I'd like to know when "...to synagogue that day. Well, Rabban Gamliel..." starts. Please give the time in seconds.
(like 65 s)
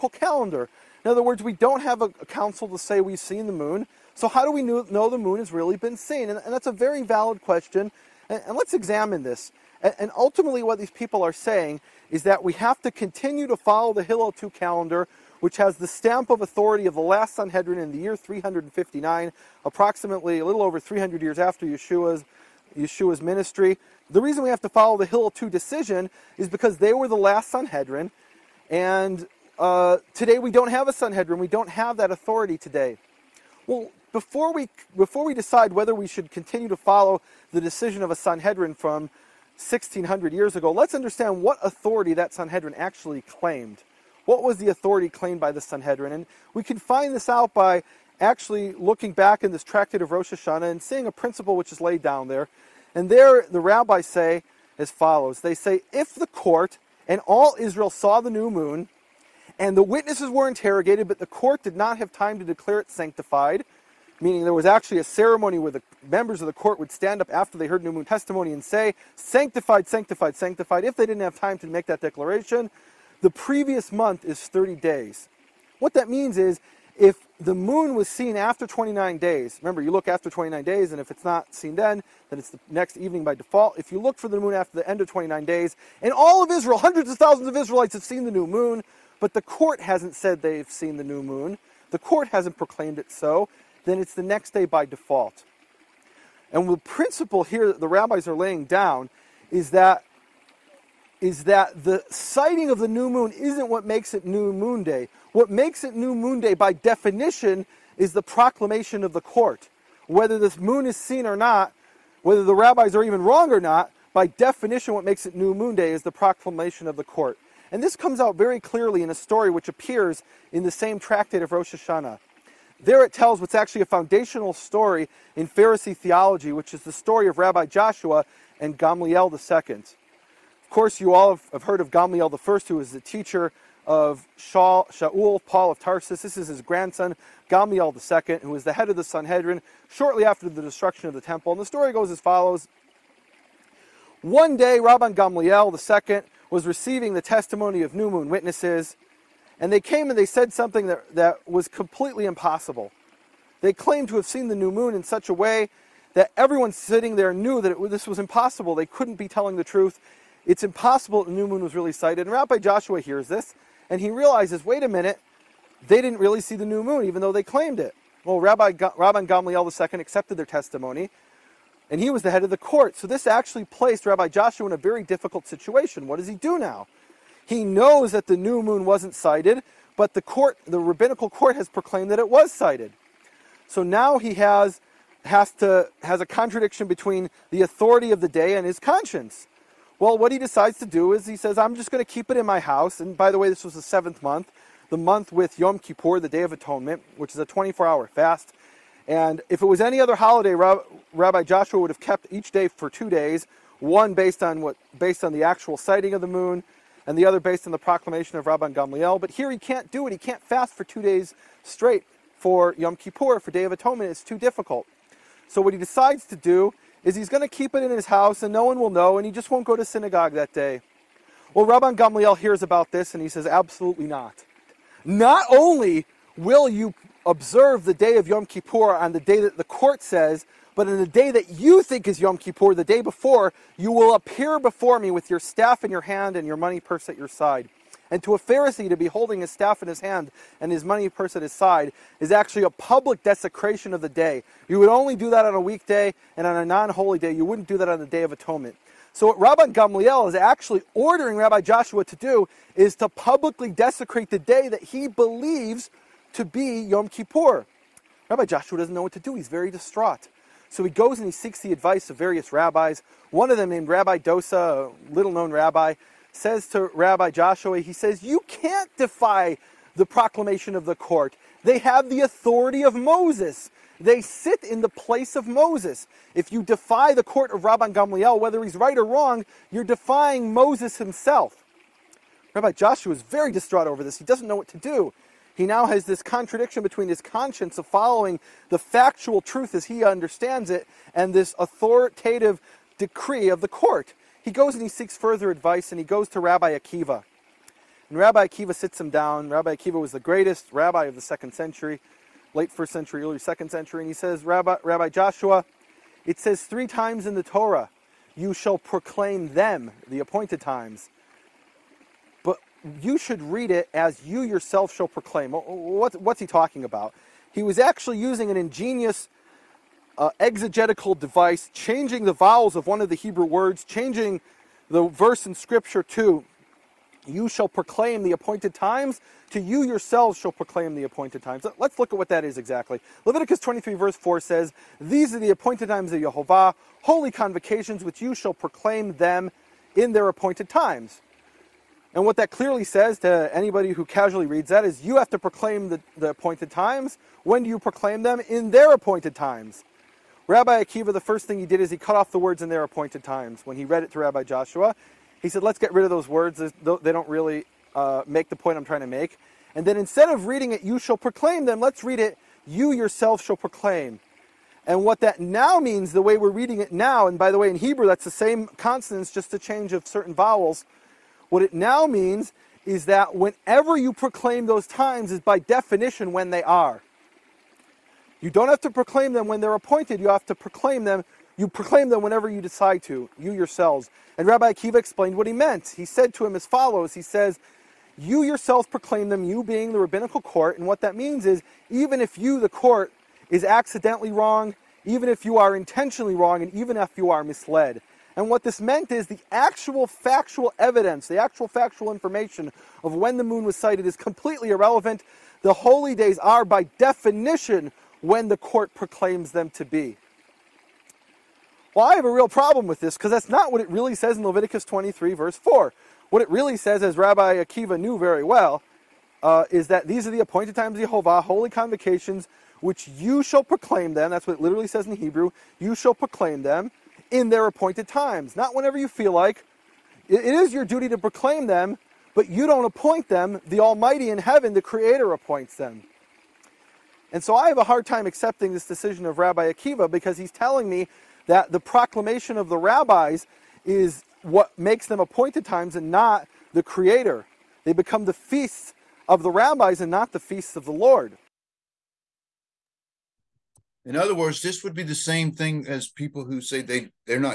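219 s.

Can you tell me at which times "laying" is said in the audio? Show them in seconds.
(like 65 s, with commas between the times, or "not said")
98 s.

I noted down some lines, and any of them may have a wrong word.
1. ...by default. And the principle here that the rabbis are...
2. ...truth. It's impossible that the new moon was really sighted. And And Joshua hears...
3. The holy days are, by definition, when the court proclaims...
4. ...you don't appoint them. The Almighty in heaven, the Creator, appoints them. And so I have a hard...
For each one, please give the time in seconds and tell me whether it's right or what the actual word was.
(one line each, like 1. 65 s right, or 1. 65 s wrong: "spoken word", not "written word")
1. 94 s right
2. 159 s wrong: "Rabbi", not "And"
3. 405 s right
4. 432 s right.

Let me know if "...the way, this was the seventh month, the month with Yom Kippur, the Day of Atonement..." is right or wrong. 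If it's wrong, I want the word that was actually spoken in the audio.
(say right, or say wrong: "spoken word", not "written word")
right.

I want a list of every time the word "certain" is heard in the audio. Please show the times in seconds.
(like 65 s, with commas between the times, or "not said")
370 s.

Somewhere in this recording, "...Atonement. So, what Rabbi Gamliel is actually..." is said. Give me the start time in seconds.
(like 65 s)
248 s.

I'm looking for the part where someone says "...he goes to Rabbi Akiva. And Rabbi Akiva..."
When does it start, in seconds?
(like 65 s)
295 s.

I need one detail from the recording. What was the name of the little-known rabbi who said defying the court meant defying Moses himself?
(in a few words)
Rabbi Dosa.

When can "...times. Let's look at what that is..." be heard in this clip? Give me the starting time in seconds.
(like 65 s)
331 s.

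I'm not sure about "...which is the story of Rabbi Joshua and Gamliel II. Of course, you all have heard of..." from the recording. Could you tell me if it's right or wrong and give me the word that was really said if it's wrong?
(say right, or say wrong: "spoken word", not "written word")
right.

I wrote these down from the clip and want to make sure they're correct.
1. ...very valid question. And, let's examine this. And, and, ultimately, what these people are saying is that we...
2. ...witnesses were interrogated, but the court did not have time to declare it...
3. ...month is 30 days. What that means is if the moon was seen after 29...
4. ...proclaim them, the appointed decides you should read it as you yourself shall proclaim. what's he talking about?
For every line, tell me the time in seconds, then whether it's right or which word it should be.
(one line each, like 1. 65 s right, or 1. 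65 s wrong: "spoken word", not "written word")
1. 6 s right
2. 59 s right
3. 73 s right
4. 308 s wrong: "times", not "decides".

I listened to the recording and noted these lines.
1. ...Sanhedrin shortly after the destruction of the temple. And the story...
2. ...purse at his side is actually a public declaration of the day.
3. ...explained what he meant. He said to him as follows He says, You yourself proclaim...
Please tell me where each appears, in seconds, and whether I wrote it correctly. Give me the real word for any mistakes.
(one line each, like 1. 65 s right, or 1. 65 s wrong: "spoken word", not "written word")
1. 139 s right
2. 241 s wrong: "desecration", not "declaration"
3. 384 s right.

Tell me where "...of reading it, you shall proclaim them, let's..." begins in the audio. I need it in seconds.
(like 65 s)
360 s.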